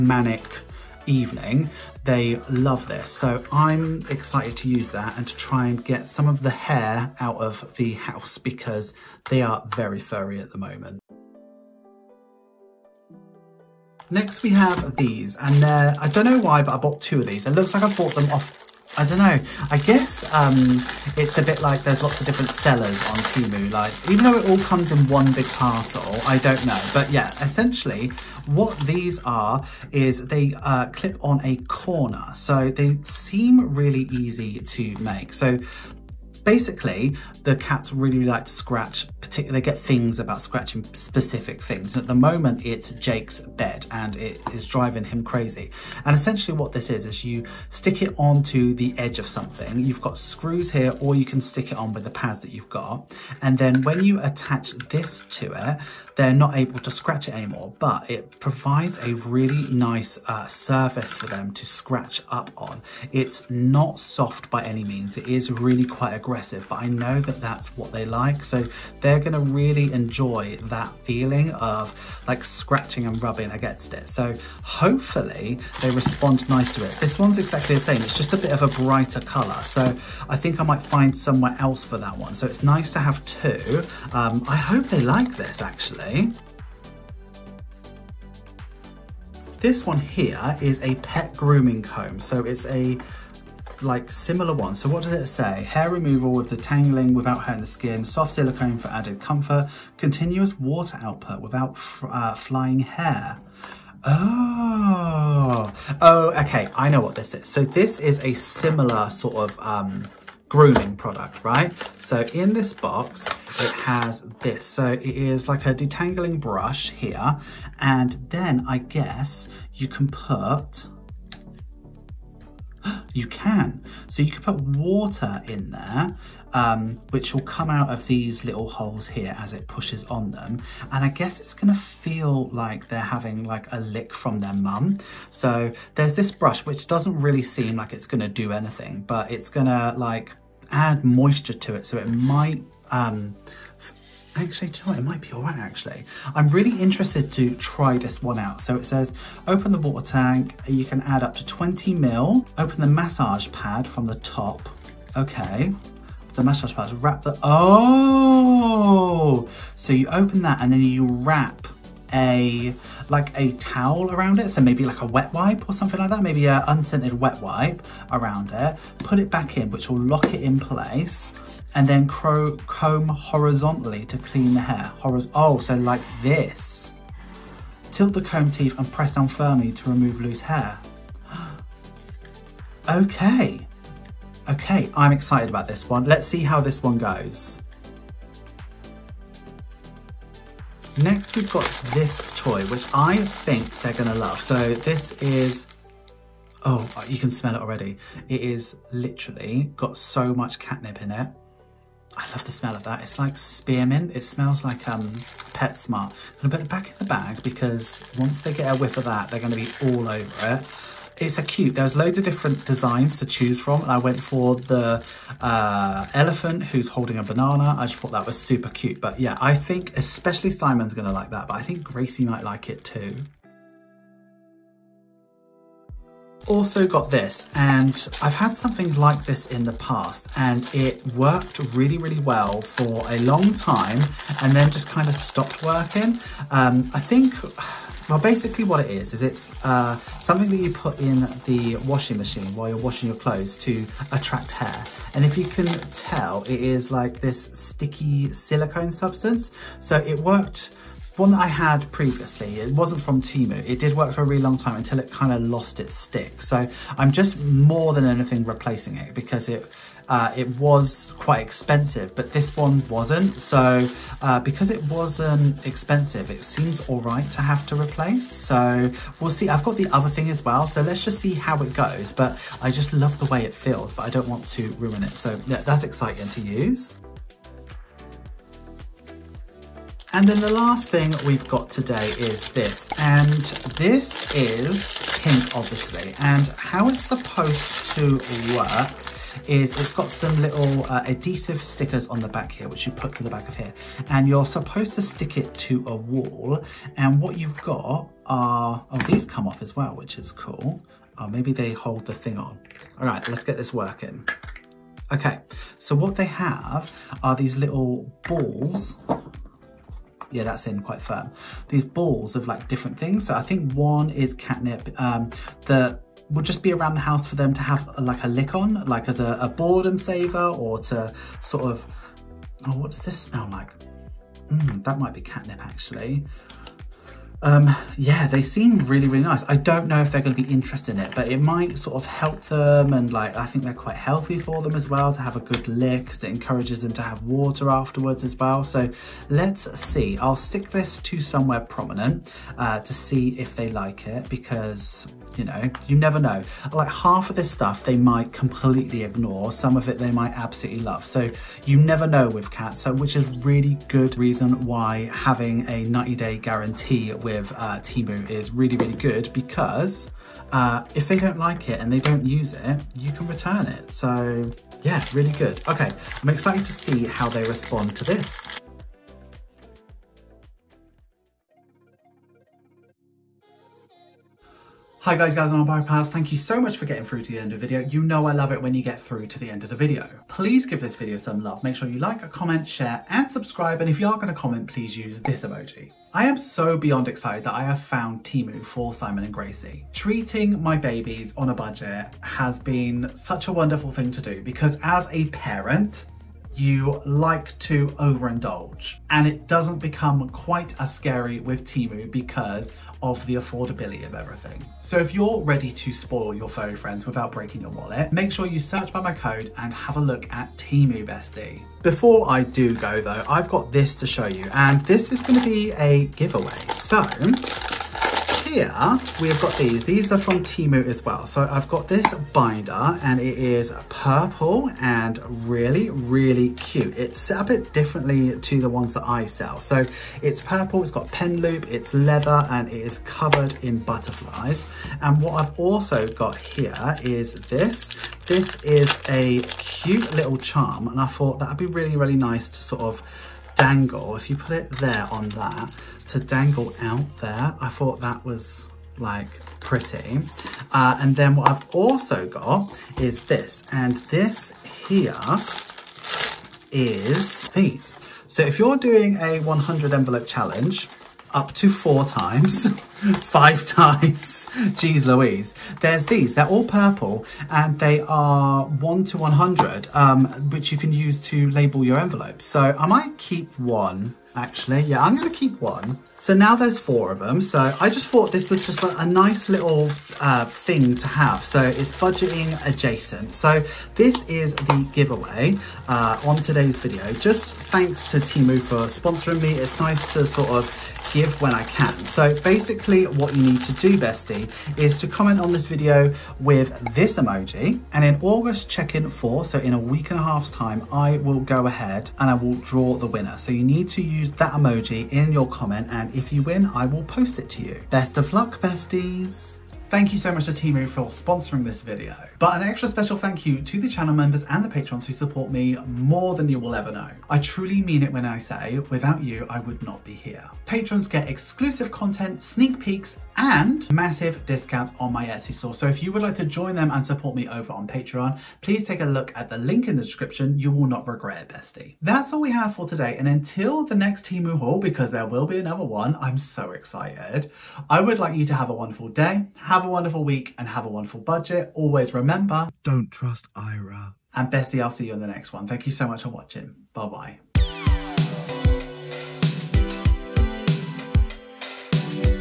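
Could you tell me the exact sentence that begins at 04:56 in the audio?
And what you've got are, oh, these come off as well, which is cool.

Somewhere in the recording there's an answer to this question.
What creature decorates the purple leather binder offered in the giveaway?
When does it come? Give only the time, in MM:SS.
07:13.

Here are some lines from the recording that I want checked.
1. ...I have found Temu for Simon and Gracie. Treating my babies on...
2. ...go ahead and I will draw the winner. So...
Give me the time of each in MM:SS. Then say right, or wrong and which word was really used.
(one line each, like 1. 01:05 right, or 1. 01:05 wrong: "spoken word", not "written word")
1. 06:27 right
2. 08:21 right.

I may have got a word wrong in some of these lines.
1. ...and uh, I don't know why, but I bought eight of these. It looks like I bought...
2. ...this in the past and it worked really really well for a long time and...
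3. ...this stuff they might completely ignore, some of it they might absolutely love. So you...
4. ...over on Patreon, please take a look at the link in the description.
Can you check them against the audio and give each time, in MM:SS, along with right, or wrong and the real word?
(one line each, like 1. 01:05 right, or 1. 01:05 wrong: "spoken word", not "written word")
1. 00:15 wrong: "two", not "eight"
2. 03:49 right
3. 05:47 right
4. 08:47 right.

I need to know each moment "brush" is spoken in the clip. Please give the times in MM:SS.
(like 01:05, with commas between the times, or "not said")
01:56, 02:16.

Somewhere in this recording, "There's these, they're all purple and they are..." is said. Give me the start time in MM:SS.
07:45.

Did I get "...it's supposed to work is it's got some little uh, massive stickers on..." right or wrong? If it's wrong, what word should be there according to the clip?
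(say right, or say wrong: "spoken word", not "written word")
wrong: "adhesive", not "massive".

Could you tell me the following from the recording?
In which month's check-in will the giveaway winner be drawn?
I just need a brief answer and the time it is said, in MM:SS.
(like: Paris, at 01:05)
August, at 08:18.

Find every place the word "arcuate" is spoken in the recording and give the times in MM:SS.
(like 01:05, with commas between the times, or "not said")
not said.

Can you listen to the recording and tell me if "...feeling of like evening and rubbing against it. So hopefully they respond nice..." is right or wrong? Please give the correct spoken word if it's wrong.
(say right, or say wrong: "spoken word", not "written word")
wrong: "scratching", not "evening".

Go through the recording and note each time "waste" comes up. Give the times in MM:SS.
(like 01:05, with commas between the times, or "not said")
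not said.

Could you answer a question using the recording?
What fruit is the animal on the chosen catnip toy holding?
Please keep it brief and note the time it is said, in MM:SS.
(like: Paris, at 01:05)
Banana, at 03:37.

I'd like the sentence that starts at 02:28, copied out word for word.
So it says, open the water tank.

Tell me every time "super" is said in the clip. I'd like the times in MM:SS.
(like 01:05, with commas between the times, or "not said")
03:38.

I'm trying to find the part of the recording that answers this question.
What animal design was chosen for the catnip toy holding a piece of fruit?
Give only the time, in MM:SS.
03:36.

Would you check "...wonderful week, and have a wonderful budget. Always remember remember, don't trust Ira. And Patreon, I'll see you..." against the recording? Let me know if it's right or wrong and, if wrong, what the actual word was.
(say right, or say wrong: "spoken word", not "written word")
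wrong: "Bestie", not "Patreon".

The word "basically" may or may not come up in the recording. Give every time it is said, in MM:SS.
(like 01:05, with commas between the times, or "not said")
00:36, 03:58, 08:12.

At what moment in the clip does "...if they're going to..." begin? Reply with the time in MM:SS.
05:29.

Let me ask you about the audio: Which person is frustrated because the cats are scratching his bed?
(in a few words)
Jake.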